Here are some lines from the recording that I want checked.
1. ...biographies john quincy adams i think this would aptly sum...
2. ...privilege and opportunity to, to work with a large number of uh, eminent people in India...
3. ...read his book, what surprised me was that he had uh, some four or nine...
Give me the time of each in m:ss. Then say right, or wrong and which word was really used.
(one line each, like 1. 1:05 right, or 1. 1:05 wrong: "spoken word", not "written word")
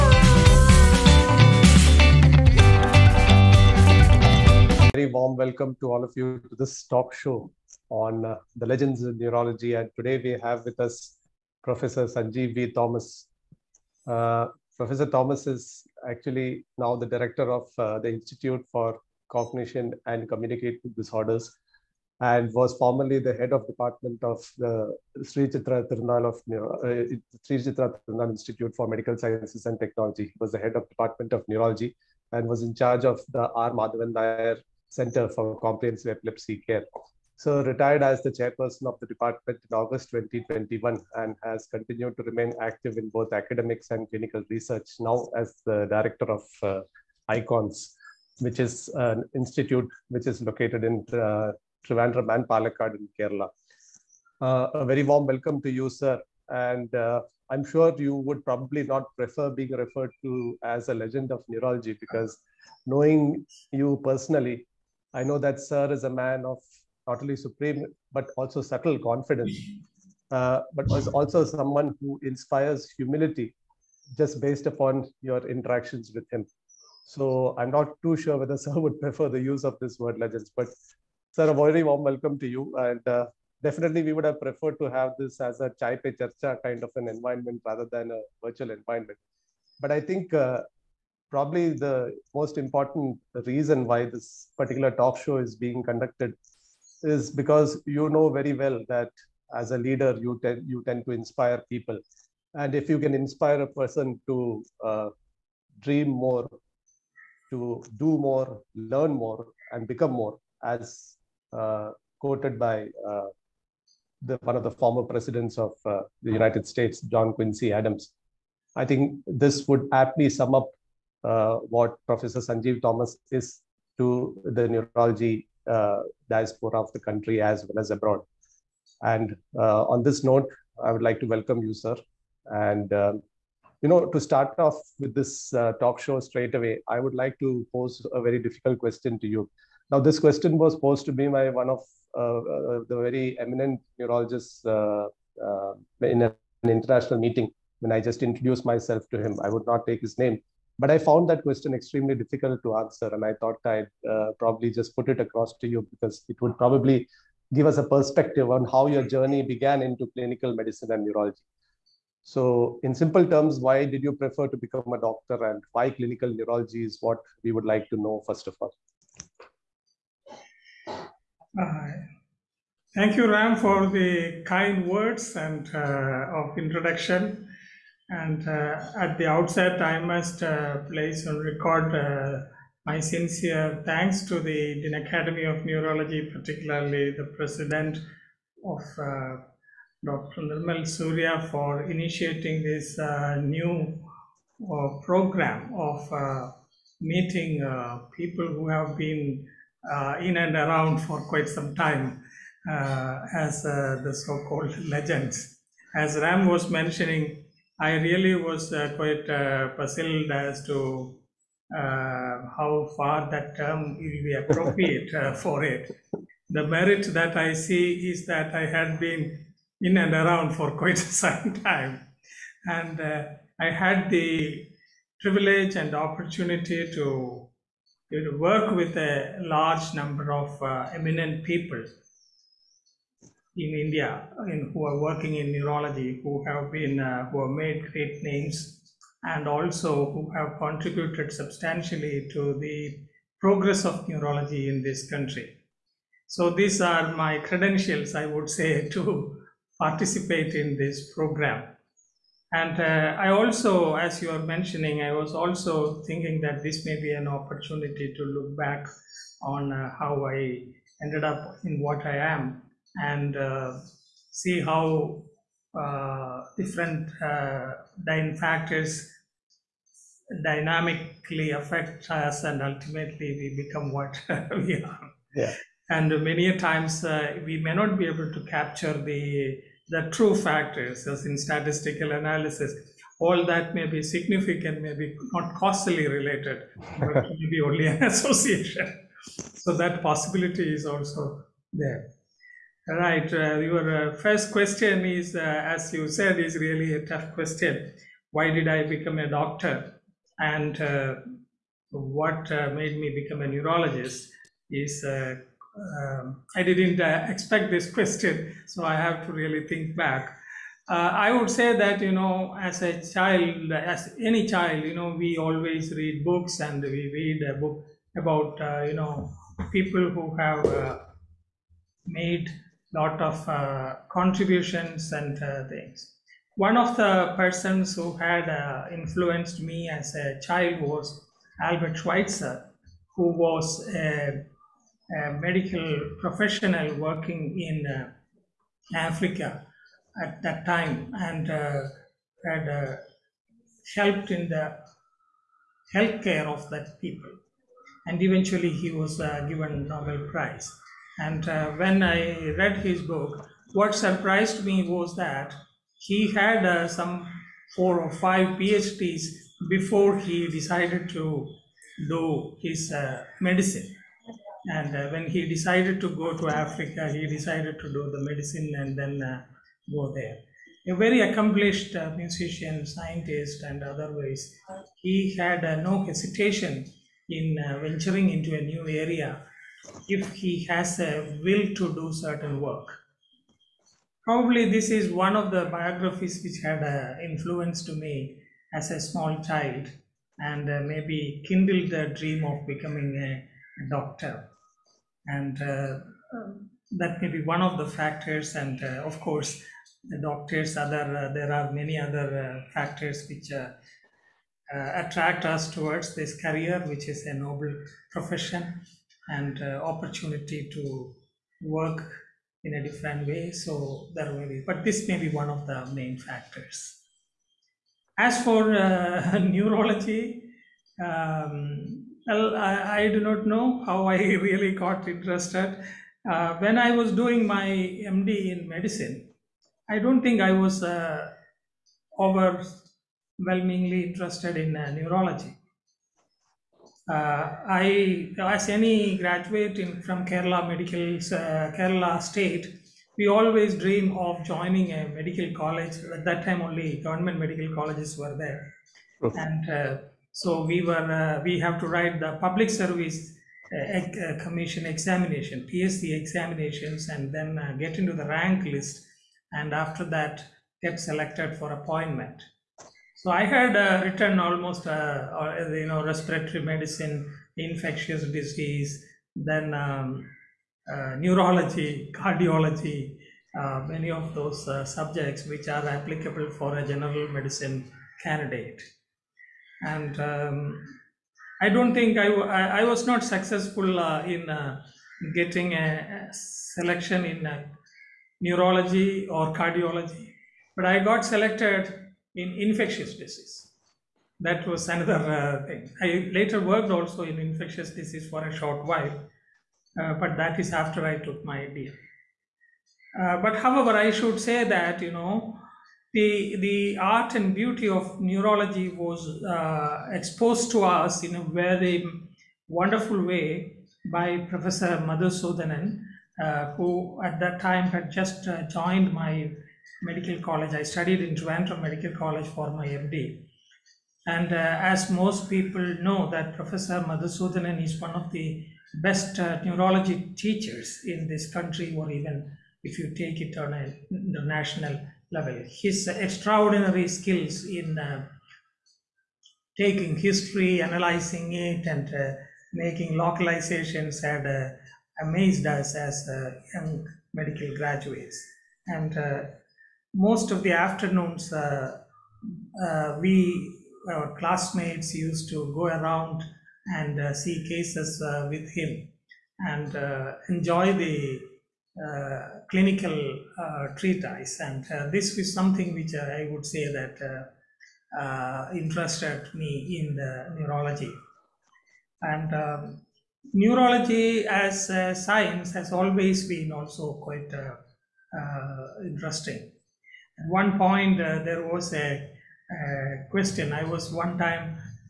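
1. 1:56 wrong: "states", not "biographies"
2. 3:45 right
3. 5:52 wrong: "five", not "nine".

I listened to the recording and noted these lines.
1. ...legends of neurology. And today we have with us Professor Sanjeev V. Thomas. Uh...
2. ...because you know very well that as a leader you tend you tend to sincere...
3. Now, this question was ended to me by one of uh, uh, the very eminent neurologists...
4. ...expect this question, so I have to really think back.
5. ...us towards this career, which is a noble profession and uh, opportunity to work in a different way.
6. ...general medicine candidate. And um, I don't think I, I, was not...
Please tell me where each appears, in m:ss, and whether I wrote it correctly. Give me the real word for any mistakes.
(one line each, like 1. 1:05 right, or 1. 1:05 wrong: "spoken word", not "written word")
1. 0:08 right
2. 1:37 wrong: "inspire", not "sincere"
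3. 2:19 wrong: "posed", not "ended"
4. 5:07 right
5. 6:45 right
6. 7:56 right.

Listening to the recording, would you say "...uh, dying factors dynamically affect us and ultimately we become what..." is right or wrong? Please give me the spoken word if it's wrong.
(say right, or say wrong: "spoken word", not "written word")
right.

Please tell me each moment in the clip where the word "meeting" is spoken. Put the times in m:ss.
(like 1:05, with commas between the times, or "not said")
2:27, 3:16.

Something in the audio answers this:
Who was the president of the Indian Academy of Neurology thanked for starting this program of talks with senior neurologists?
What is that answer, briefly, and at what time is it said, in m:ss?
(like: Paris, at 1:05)
Dr. Nirmal Surya, at 3:10.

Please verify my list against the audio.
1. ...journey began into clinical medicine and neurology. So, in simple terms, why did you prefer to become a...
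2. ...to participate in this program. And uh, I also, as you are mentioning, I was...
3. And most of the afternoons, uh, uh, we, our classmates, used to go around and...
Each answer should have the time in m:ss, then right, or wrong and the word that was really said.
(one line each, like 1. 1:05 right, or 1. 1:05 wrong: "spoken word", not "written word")
1. 2:39 right
2. 4:08 right
3. 9:08 right.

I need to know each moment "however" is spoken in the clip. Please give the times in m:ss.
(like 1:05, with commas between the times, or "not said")
8:23.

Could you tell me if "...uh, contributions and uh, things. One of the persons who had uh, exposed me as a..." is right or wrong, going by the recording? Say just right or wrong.
wrong.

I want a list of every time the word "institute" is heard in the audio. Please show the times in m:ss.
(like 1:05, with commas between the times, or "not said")
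0:18, 0:28, 0:49.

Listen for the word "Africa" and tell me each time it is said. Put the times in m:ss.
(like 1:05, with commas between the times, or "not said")
5:38, 6:06.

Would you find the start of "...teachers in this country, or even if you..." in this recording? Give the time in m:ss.
8:50.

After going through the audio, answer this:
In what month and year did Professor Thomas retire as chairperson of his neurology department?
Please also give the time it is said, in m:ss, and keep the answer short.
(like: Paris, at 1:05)
August 2021, at 0:39.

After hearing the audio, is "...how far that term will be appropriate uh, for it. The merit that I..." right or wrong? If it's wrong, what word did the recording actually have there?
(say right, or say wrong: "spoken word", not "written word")
right.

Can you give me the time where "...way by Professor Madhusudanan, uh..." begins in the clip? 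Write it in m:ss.
8:33.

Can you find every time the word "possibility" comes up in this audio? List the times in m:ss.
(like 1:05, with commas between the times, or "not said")
4:50.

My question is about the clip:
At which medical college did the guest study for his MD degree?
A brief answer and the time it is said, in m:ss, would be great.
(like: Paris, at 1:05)
Trivandrum Medical College, at 8:41.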